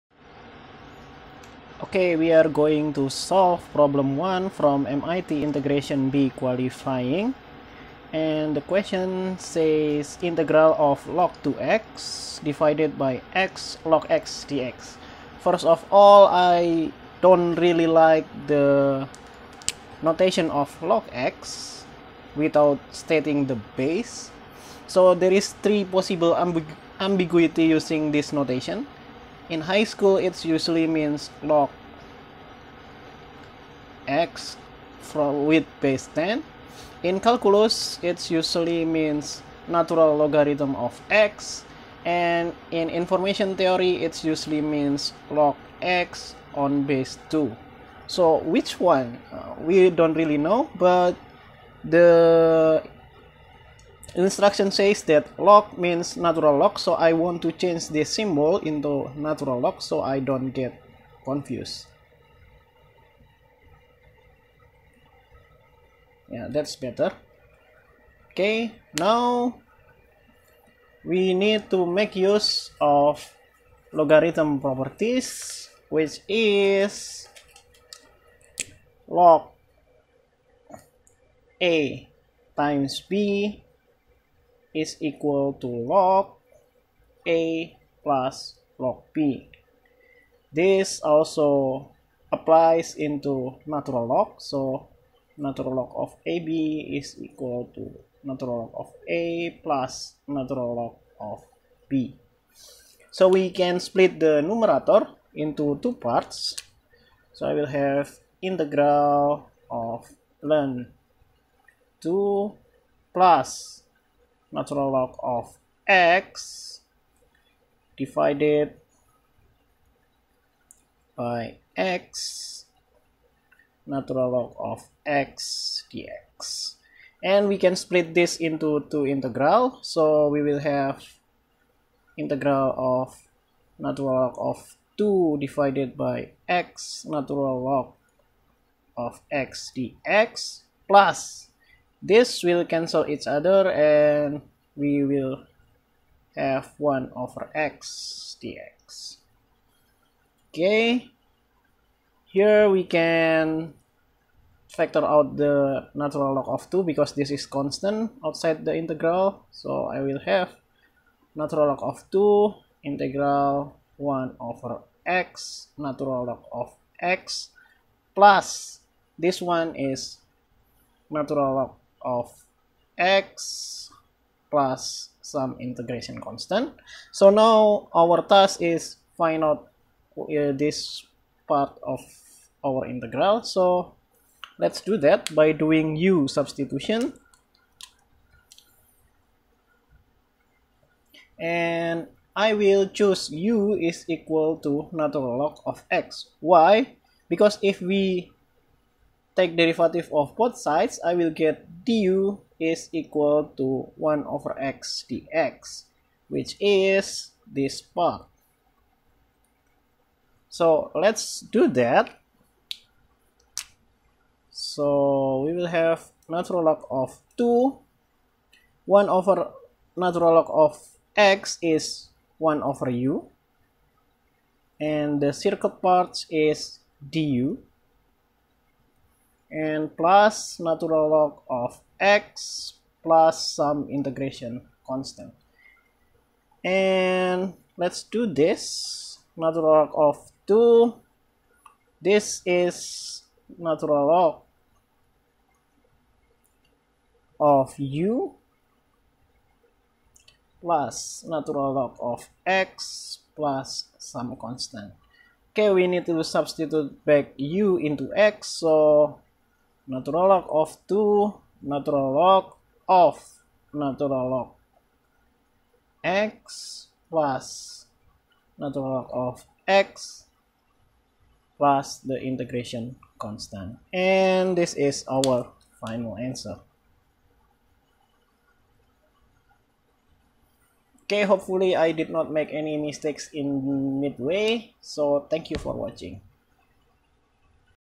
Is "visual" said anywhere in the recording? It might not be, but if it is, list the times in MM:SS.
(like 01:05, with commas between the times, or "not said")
not said.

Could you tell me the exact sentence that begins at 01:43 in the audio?
So we can split the numerator into two parts.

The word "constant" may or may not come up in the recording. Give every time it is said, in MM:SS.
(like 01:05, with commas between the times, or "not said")
02:37, 02:56, 03:54, 04:14, 04:33.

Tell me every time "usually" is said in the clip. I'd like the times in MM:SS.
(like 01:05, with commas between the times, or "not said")
00:30, 00:38, 00:44.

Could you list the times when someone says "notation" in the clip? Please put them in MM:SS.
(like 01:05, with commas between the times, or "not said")
00:20, 00:28.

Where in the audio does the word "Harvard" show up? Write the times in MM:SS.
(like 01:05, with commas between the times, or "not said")
not said.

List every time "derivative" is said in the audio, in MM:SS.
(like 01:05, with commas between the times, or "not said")
03:19.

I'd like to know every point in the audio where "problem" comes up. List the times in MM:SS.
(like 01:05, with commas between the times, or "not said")
00:03.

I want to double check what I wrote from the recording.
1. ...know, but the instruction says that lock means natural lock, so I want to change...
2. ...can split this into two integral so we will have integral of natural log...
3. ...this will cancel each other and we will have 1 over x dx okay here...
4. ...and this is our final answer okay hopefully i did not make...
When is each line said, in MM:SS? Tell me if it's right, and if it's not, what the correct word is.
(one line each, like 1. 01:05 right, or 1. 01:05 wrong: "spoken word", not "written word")
1. 00:50 right
2. 02:07 right
3. 02:22 right
4. 04:33 right.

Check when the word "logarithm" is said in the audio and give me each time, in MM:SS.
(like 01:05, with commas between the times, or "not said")
00:40, 01:13.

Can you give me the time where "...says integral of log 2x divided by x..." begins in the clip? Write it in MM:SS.
00:09.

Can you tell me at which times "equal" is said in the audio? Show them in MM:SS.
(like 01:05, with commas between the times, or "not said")
01:25, 01:37, 03:14, 03:22.